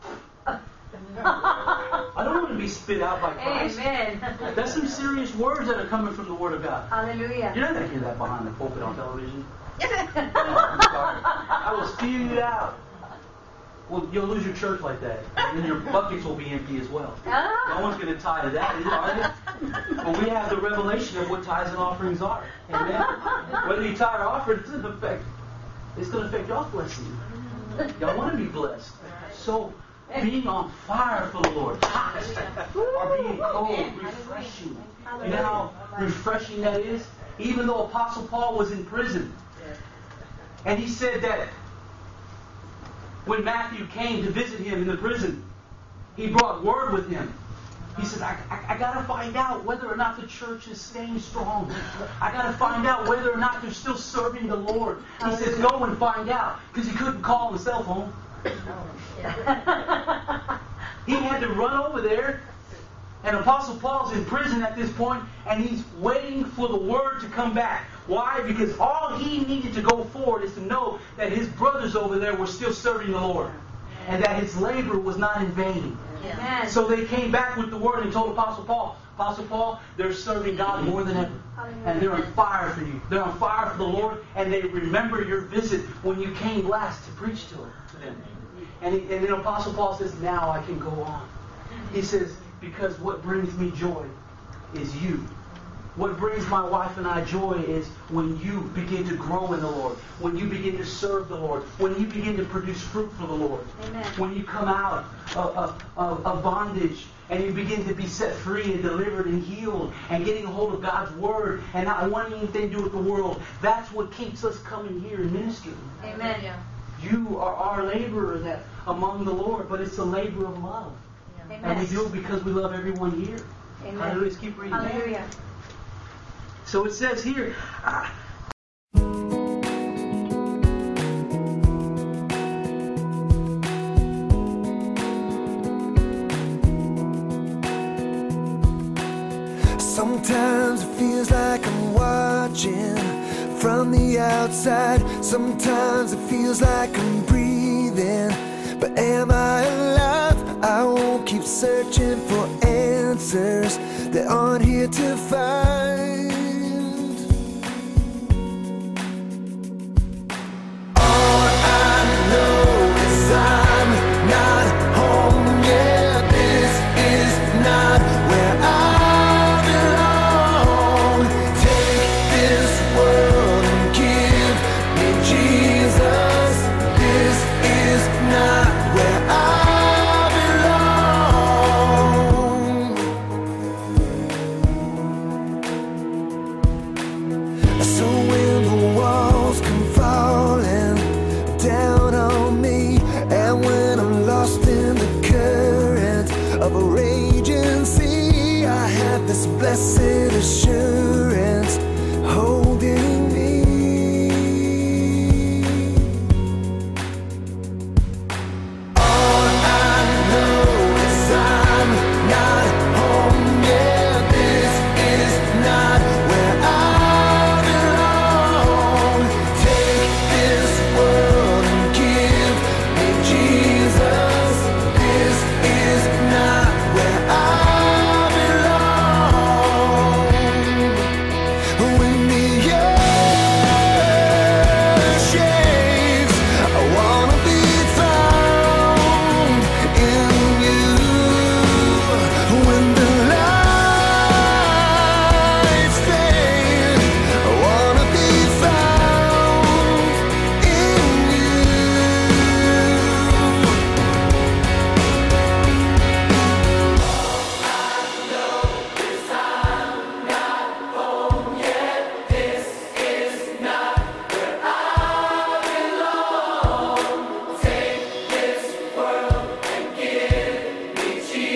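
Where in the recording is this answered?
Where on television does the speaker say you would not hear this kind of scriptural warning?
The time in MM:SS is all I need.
00:08.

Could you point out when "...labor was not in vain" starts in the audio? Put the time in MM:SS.
01:14.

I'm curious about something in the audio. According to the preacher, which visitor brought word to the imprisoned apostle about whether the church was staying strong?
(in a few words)
Matthew.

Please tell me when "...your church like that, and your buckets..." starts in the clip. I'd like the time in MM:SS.
00:14.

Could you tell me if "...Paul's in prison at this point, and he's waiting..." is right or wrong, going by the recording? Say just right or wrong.
right.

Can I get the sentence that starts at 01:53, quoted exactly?
That's what keeps us coming here and ministering.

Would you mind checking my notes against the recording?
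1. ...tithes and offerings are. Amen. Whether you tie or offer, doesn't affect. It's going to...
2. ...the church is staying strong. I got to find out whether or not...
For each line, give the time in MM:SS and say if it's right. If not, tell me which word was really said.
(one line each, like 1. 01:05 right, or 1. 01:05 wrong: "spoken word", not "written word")
1. 00:21 right
2. 00:50 right.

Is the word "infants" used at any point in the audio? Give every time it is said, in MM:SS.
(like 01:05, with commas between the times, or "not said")
not said.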